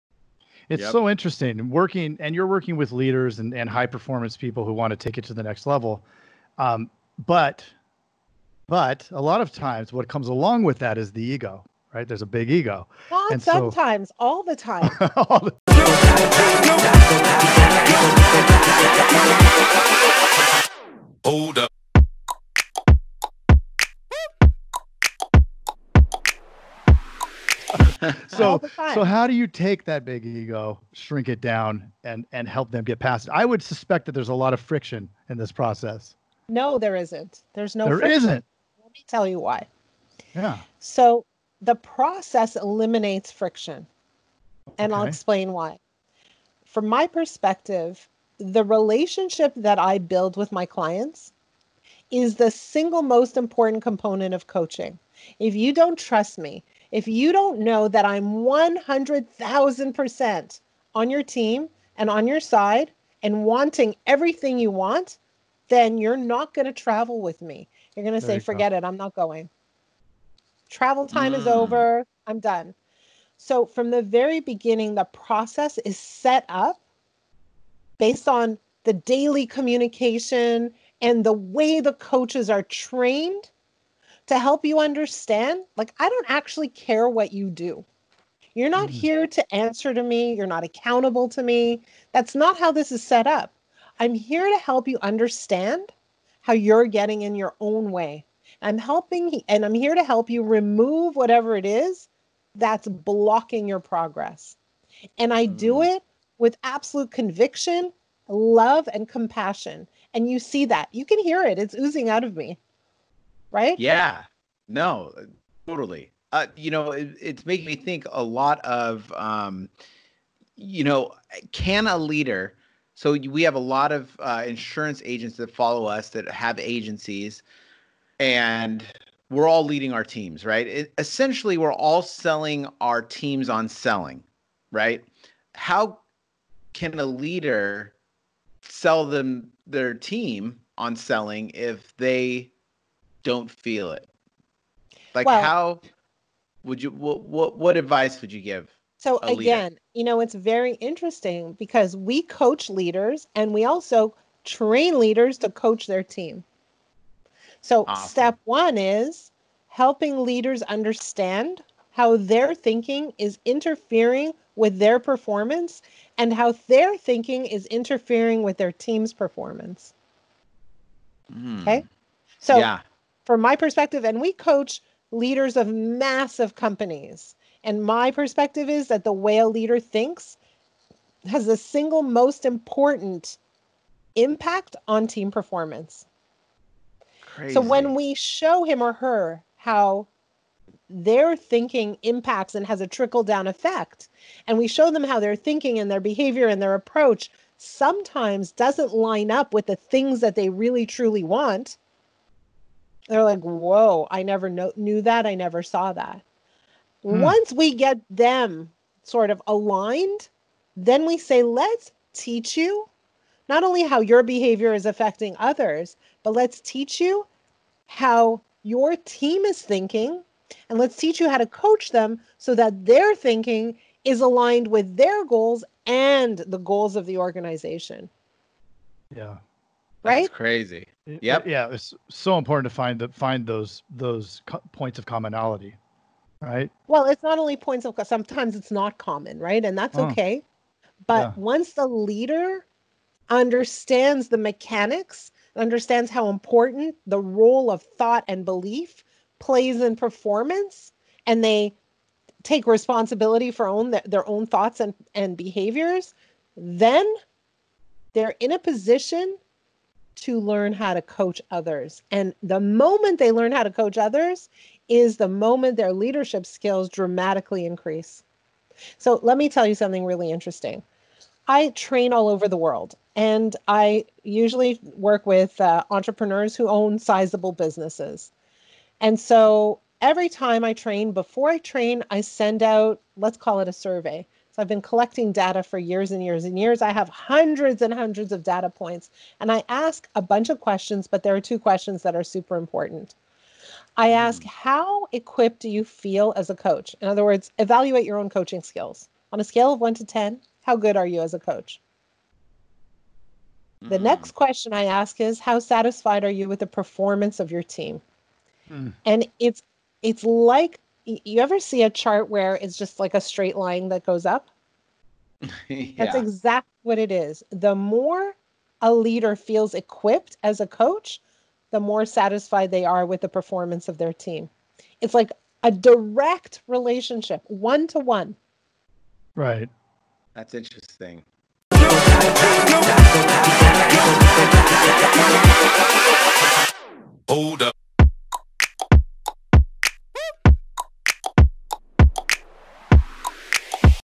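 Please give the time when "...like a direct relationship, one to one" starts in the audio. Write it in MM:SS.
05:25.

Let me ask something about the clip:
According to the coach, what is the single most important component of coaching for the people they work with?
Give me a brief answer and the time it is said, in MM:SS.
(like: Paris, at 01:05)
The relationship, at 00:48.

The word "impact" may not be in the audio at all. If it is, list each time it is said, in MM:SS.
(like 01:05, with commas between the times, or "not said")
03:04, 03:12.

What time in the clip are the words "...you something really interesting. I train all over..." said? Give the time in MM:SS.
04:29.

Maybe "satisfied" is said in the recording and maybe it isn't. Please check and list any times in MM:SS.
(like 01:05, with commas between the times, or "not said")
05:05, 05:22.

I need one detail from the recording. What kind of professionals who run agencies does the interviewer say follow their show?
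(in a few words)
Insurance agents.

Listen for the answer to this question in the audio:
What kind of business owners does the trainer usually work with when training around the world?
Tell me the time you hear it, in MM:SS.
04:35.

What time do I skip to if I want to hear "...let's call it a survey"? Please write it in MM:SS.
04:43.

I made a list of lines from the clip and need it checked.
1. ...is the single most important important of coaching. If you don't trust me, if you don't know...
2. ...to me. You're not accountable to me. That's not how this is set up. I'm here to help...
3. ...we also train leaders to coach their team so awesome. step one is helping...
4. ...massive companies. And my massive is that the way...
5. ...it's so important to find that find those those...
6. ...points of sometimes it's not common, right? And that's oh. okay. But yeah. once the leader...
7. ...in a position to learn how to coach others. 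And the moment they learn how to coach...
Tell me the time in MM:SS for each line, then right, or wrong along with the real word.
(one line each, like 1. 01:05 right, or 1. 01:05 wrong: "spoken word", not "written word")
1. 00:52 wrong: "component", not "important"
2. 01:29 right
3. 02:33 right
4. 02:55 wrong: "perspective", not "massive"
5. 03:51 right
6. 03:57 right
7. 04:18 right.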